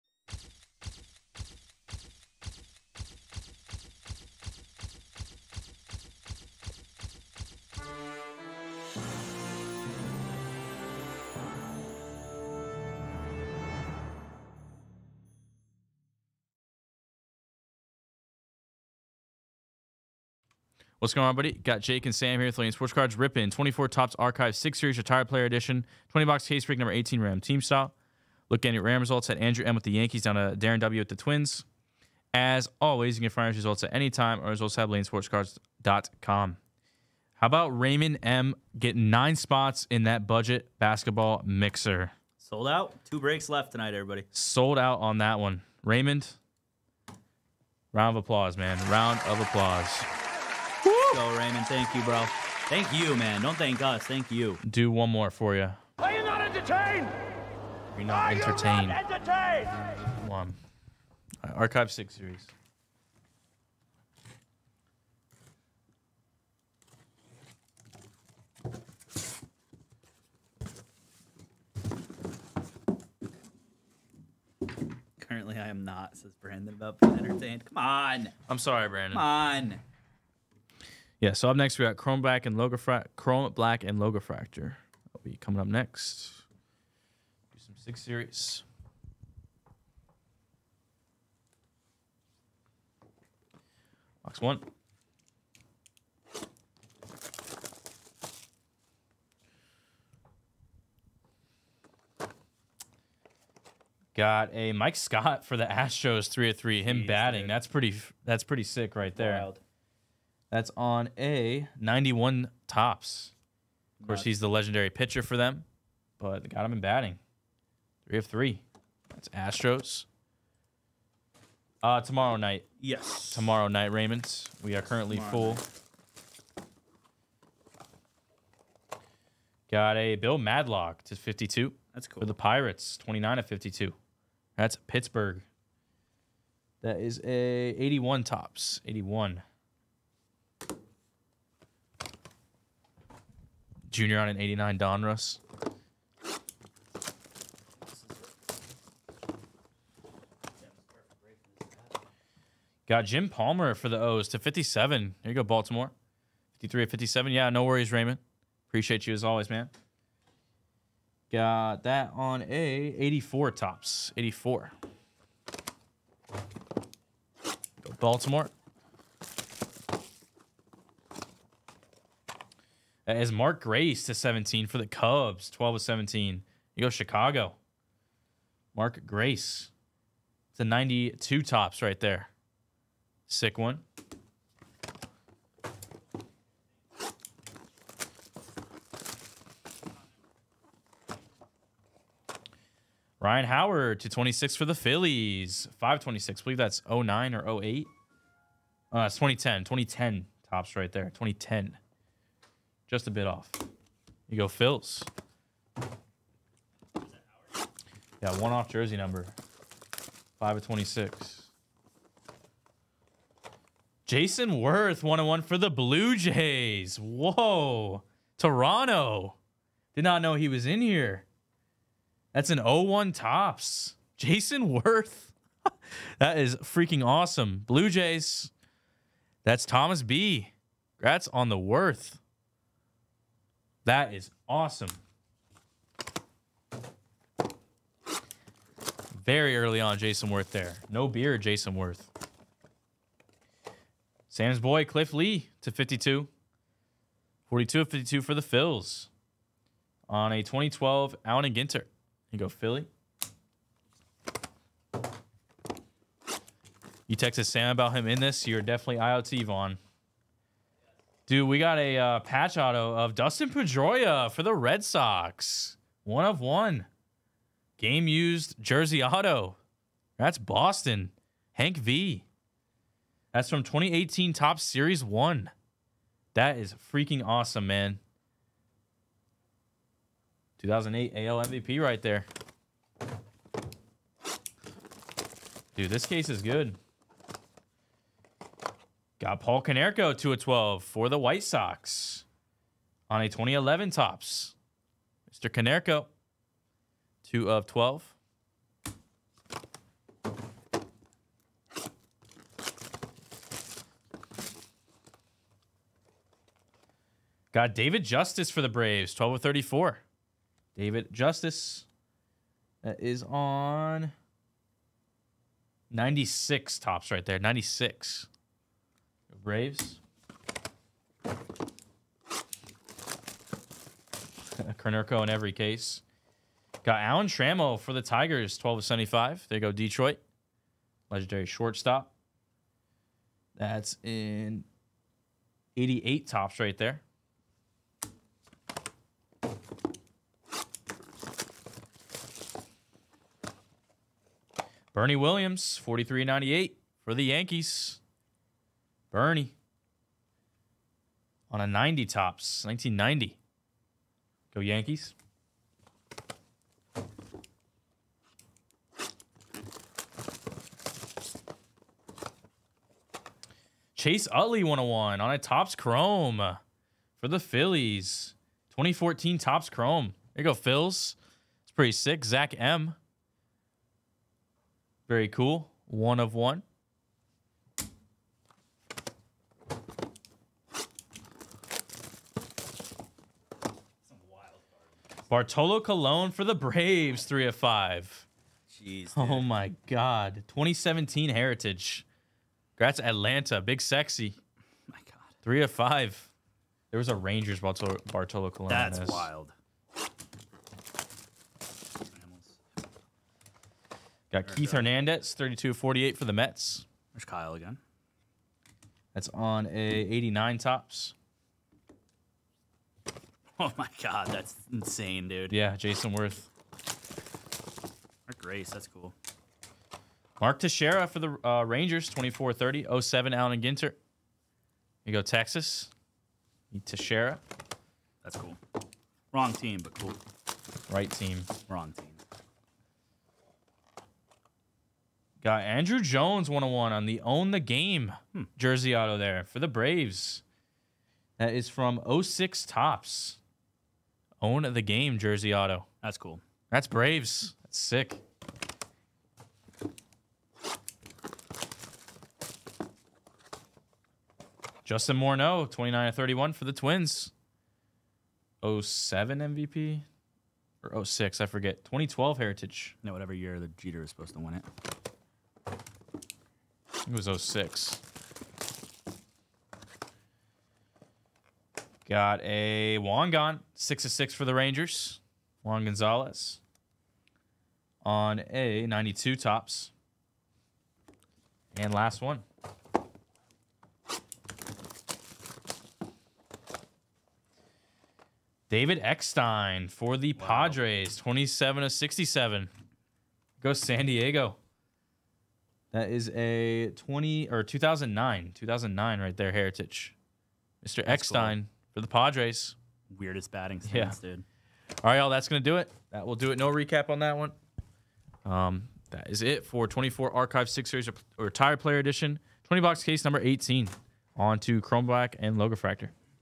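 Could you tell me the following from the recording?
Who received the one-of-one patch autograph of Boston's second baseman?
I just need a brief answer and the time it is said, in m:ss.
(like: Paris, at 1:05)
Hank V, at 4:31.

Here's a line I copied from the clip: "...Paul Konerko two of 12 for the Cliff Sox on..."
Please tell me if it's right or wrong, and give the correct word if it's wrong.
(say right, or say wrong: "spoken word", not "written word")
wrong: "White", not "Cliff".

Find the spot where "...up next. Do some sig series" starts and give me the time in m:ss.
1:25.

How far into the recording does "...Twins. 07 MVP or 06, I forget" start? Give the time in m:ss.
7:36.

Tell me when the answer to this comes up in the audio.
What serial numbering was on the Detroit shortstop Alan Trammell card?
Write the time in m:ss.
5:28.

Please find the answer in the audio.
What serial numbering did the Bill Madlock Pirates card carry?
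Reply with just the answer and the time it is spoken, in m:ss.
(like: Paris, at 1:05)
29 of 52, at 2:12.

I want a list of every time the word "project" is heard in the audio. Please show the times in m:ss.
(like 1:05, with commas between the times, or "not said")
not said.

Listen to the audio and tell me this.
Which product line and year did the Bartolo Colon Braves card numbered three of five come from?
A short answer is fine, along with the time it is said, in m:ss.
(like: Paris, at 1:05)
2017 Heritage, at 6:30.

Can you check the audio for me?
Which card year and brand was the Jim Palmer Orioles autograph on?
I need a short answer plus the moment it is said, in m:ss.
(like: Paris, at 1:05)
84 Topps, at 2:42.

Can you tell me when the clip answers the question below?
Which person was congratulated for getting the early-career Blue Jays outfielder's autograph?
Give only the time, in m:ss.
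3:49.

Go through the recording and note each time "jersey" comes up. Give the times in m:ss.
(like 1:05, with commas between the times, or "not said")
3:28, 4:28, 7:18, 7:25.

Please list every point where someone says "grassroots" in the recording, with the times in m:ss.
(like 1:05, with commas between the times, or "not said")
not said.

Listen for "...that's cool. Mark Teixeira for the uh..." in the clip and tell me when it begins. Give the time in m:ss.
6:58.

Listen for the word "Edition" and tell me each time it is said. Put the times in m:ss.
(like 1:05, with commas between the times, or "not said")
0:25, 8:31.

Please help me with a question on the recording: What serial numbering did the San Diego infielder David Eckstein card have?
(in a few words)
27 of 67.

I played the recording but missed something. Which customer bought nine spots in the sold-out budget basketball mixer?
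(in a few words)
Raymond M.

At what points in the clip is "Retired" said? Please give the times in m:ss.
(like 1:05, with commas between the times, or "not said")
0:24, 8:31.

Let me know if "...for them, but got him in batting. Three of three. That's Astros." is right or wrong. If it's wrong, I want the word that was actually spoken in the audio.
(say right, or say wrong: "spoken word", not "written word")
right.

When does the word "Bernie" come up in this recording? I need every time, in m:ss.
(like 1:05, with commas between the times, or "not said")
5:44, 5:49.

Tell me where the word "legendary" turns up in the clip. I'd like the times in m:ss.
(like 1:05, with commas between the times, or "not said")
1:54, 5:31.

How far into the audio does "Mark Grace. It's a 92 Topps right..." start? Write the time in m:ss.
2:58.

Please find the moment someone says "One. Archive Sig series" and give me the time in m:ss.
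1:00.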